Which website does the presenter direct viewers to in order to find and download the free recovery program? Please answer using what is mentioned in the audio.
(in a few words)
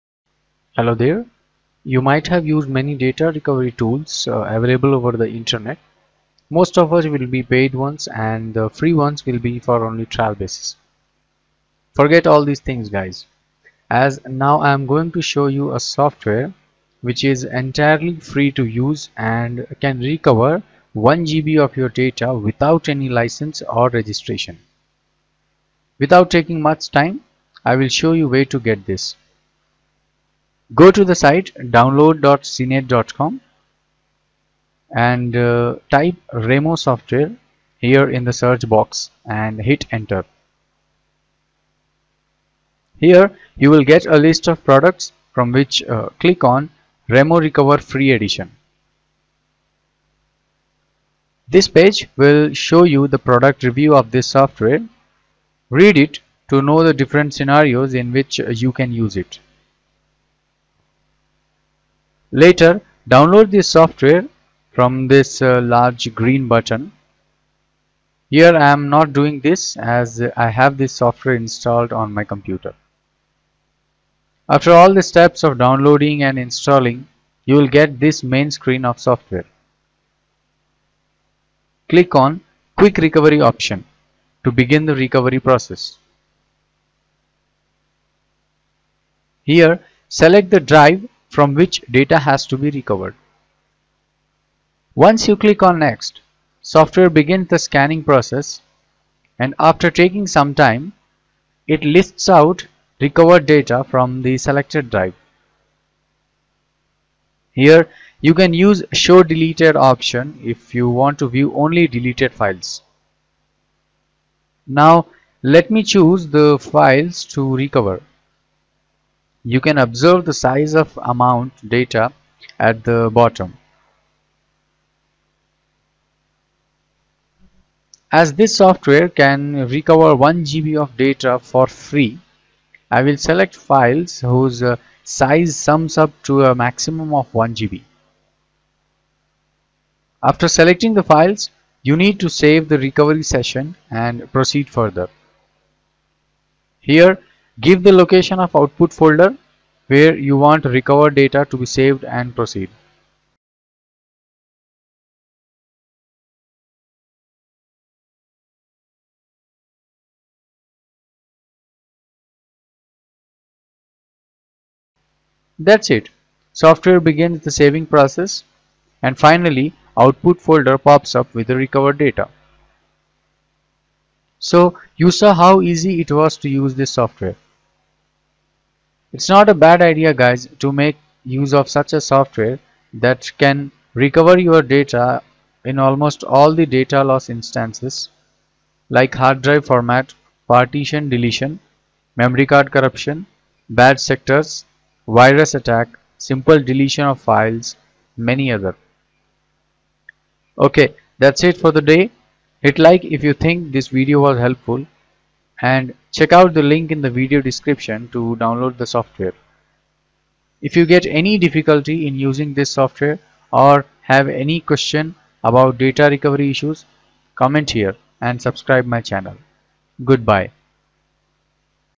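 download.cnet.com.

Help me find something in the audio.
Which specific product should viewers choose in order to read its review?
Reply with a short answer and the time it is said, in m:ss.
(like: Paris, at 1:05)
Remo Recover Free Edition, at 0:47.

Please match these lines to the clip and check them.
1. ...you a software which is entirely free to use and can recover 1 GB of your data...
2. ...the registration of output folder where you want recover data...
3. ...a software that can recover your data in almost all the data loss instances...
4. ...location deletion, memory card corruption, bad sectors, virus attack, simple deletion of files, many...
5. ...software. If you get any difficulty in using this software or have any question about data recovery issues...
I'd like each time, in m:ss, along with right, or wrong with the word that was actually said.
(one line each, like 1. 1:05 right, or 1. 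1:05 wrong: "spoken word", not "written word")
1. 0:15 right
2. 2:27 wrong: "location", not "registration"
3. 3:01 right
4. 3:10 wrong: "partition", not "location"
5. 3:28 right.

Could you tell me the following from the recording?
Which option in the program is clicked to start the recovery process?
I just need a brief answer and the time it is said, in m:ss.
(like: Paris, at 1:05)
Quick Recovery, at 1:22.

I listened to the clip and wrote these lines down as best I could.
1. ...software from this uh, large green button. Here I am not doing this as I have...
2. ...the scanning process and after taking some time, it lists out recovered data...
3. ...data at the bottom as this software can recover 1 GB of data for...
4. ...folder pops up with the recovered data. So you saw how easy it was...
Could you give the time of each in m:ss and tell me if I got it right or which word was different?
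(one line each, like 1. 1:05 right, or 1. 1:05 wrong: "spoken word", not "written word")
1. 1:03 right
2. 1:37 right
3. 2:01 right
4. 2:50 right.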